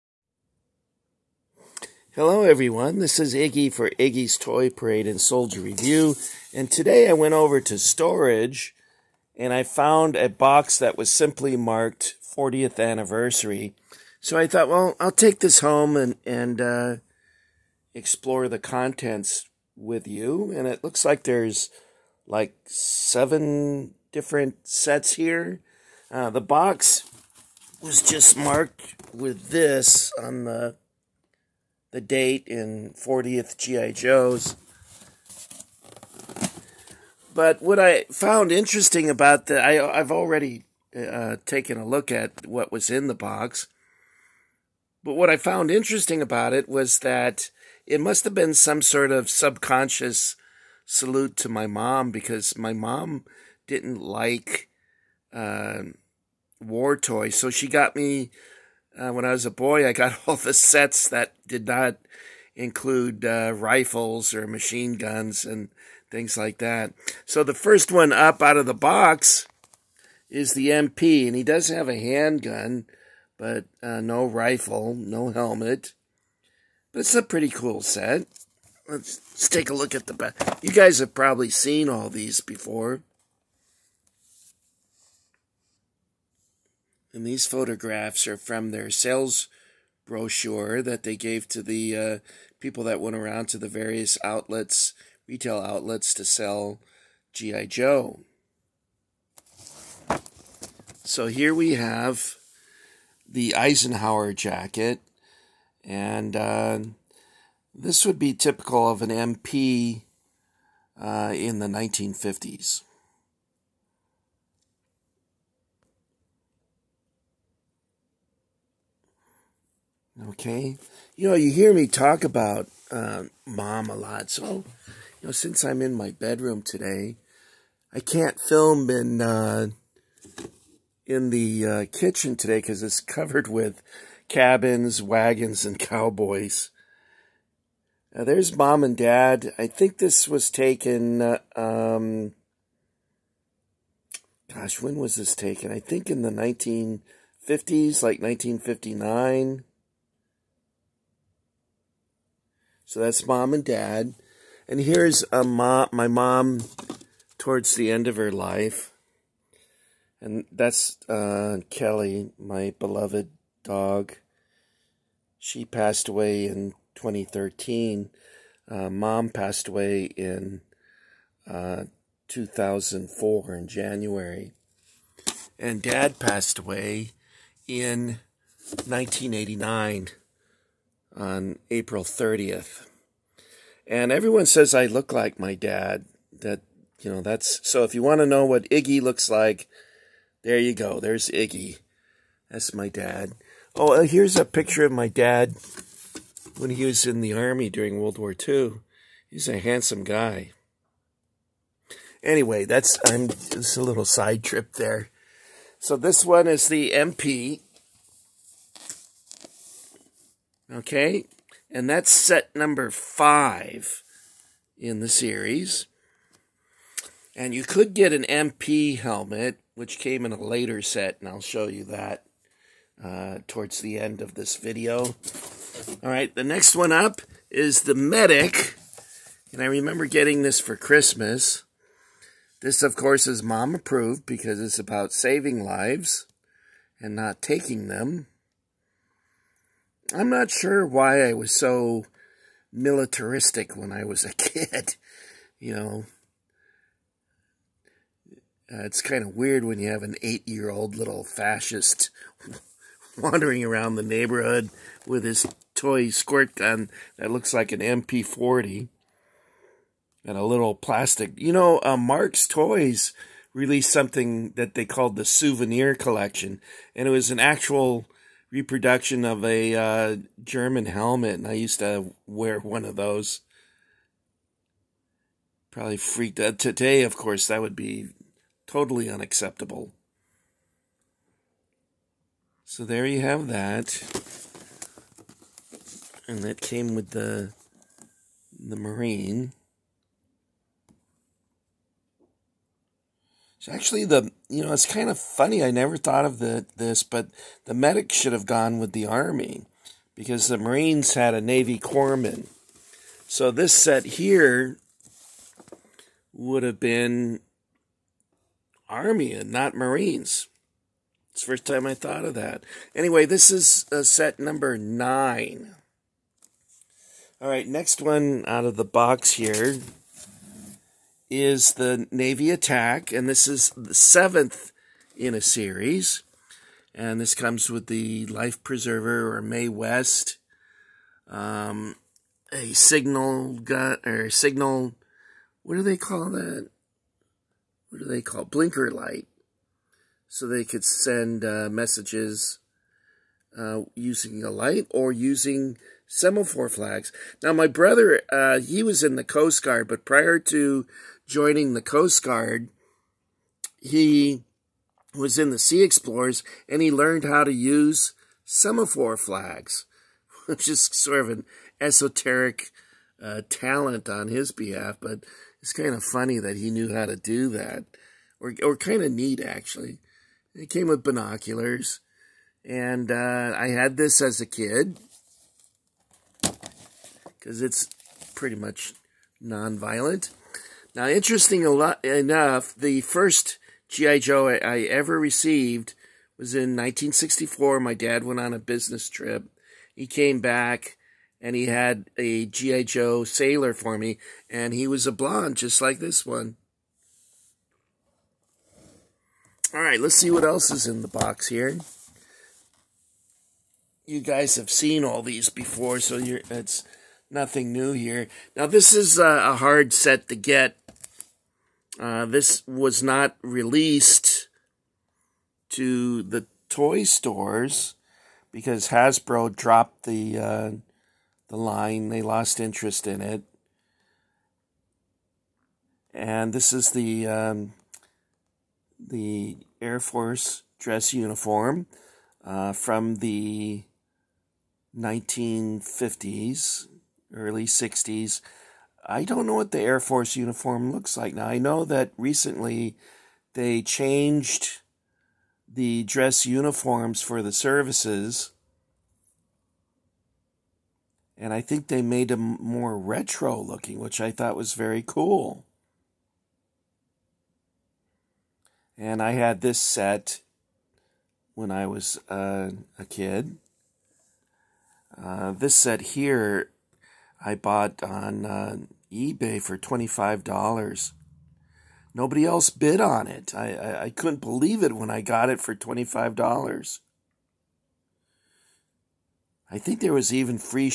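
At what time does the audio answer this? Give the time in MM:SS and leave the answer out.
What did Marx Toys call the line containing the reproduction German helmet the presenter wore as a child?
04:25.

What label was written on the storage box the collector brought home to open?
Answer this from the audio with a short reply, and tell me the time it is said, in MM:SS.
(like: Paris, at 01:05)
40th anniversary, at 00:12.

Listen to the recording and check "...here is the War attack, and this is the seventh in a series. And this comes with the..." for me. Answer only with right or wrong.
wrong.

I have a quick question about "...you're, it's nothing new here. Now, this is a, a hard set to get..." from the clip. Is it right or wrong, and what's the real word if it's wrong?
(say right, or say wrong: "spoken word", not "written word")
right.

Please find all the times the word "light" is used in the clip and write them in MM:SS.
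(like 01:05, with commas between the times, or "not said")
05:38, 05:44.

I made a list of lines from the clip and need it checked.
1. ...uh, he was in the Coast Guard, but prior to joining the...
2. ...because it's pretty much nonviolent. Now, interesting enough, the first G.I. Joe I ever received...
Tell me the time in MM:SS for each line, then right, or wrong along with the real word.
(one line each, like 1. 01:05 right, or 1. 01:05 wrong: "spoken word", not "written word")
1. 05:48 right
2. 06:17 right.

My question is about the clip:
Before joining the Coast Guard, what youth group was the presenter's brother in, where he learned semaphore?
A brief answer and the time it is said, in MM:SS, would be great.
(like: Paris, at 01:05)
Sea Explorers, at 05:55.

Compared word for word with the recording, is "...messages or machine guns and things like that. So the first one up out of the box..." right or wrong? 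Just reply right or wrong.
wrong.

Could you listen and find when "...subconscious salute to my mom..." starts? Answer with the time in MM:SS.
00:49.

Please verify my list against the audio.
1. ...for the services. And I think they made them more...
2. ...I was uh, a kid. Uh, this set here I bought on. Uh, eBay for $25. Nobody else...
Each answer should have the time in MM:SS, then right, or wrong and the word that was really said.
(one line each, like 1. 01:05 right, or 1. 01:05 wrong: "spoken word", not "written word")
1. 07:27 right
2. 07:41 right.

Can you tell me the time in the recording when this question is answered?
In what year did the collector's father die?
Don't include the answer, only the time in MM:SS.
02:58.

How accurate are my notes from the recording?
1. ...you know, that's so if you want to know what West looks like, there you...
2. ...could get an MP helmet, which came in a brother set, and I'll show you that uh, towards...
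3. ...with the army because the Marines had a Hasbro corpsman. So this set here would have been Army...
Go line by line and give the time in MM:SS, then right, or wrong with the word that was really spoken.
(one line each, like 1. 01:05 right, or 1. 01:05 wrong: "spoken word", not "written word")
1. 03:06 wrong: "Iggy", not "West"
2. 03:37 wrong: "later", not "brother"
3. 04:58 wrong: "Navy", not "Hasbro".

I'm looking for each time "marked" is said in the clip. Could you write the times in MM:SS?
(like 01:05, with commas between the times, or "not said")
00:11, 00:28.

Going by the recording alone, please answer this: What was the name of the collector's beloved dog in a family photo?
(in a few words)
Kelly.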